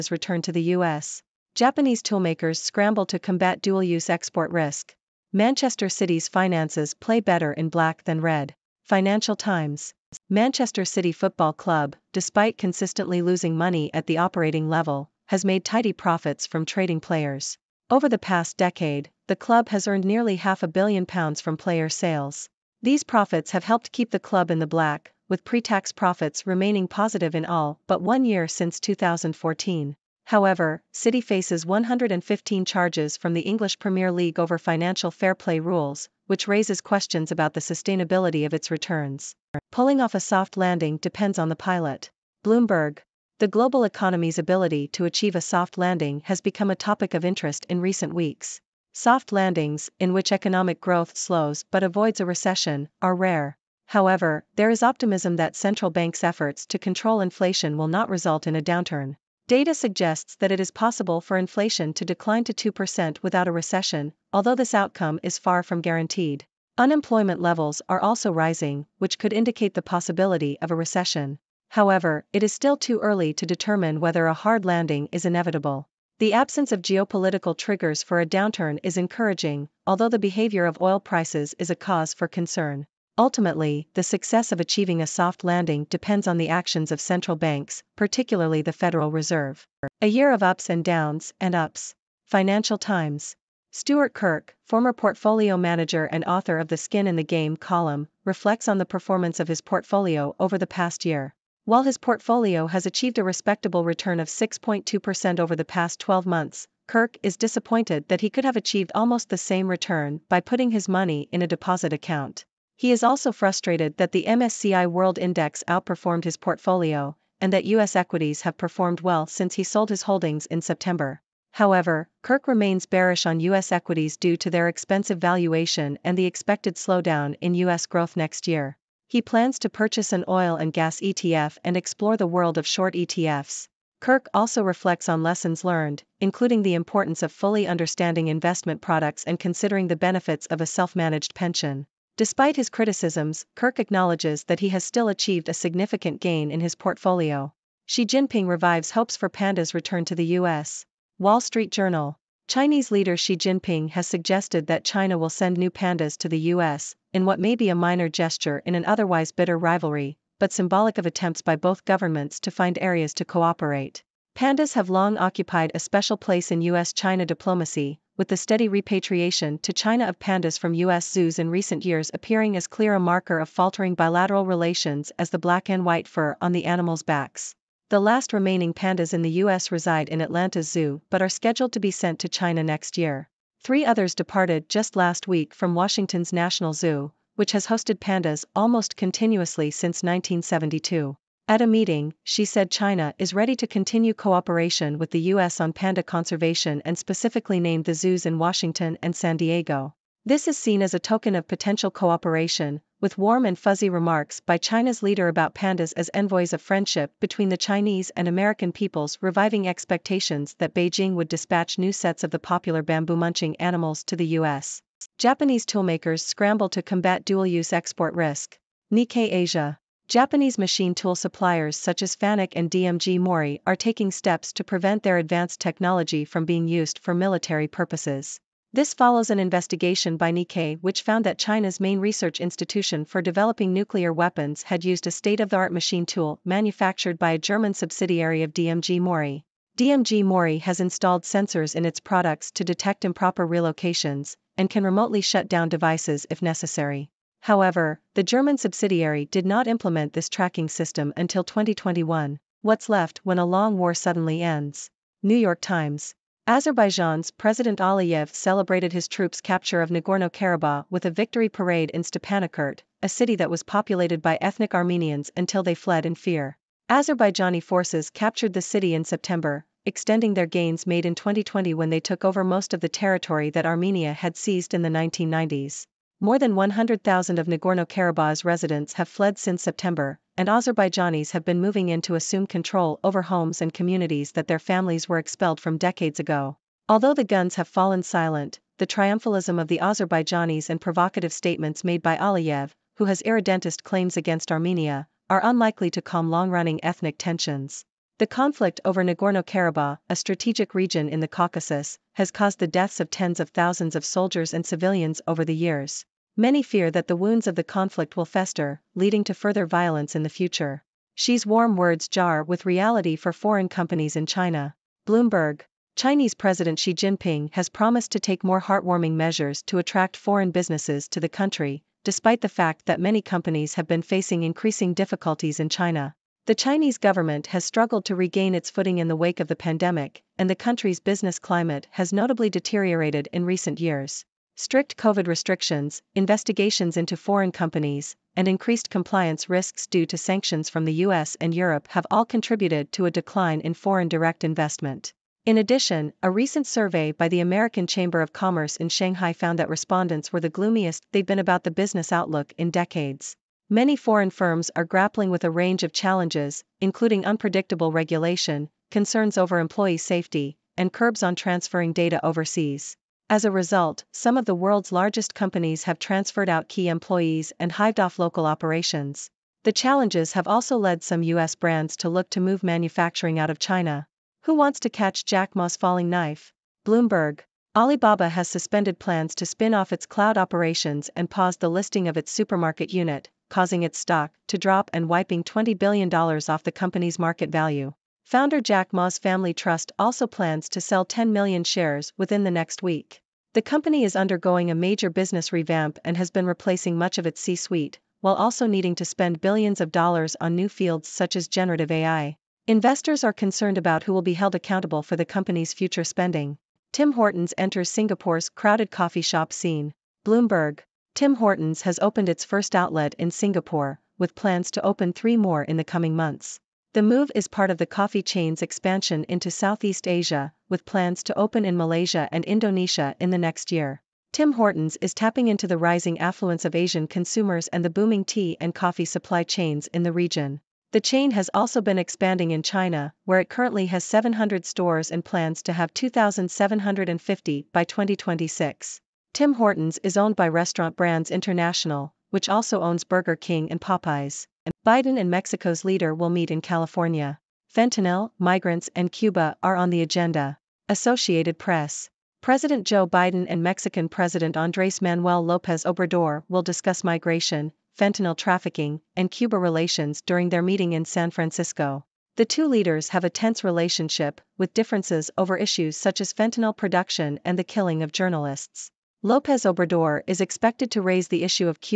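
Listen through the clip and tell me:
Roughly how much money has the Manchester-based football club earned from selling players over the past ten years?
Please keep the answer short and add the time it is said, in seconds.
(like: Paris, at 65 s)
nearly half a billion pounds, at 20 s.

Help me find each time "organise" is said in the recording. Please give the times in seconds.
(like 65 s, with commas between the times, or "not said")
not said.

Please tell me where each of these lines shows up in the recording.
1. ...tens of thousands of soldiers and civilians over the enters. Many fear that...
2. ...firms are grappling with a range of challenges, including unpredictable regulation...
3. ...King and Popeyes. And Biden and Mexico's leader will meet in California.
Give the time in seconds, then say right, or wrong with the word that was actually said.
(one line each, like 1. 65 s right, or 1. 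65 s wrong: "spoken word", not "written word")
1. 303 s wrong: "years", not "enters"
2. 354 s right
3. 443 s right.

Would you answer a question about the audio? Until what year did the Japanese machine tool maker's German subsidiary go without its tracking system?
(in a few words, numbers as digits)
2021.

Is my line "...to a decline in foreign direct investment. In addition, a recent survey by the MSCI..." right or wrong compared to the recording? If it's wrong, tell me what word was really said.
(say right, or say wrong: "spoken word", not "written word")
wrong: "American", not "MSCI".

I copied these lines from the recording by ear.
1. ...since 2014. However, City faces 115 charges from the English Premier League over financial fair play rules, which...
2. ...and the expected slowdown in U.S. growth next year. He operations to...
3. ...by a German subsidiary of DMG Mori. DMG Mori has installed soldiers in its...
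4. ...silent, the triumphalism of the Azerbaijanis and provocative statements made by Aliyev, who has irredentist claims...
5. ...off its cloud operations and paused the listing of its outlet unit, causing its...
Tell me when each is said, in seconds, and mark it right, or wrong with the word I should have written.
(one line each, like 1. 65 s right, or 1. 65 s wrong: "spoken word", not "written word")
1. 28 s right
2. 126 s wrong: "plans", not "operations"
3. 237 s wrong: "sensors", not "soldiers"
4. 288 s right
5. 379 s wrong: "supermarket", not "outlet".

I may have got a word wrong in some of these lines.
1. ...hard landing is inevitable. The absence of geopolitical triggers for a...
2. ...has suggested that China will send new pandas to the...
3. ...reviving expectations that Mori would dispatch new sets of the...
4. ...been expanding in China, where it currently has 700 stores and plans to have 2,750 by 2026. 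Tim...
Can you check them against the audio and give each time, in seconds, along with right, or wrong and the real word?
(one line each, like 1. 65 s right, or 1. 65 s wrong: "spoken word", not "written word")
1. 74 s right
2. 153 s right
3. 209 s wrong: "Beijing", not "Mori"
4. 431 s right.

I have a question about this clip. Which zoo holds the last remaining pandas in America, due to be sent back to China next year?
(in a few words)
Atlanta Zoo.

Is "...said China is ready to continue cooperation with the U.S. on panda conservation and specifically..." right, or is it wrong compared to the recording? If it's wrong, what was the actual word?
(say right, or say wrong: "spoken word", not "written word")
right.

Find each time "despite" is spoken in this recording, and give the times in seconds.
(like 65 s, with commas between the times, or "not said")
12 s, 142 s, 322 s.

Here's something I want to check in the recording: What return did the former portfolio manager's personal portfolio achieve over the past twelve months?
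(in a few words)
6.2%.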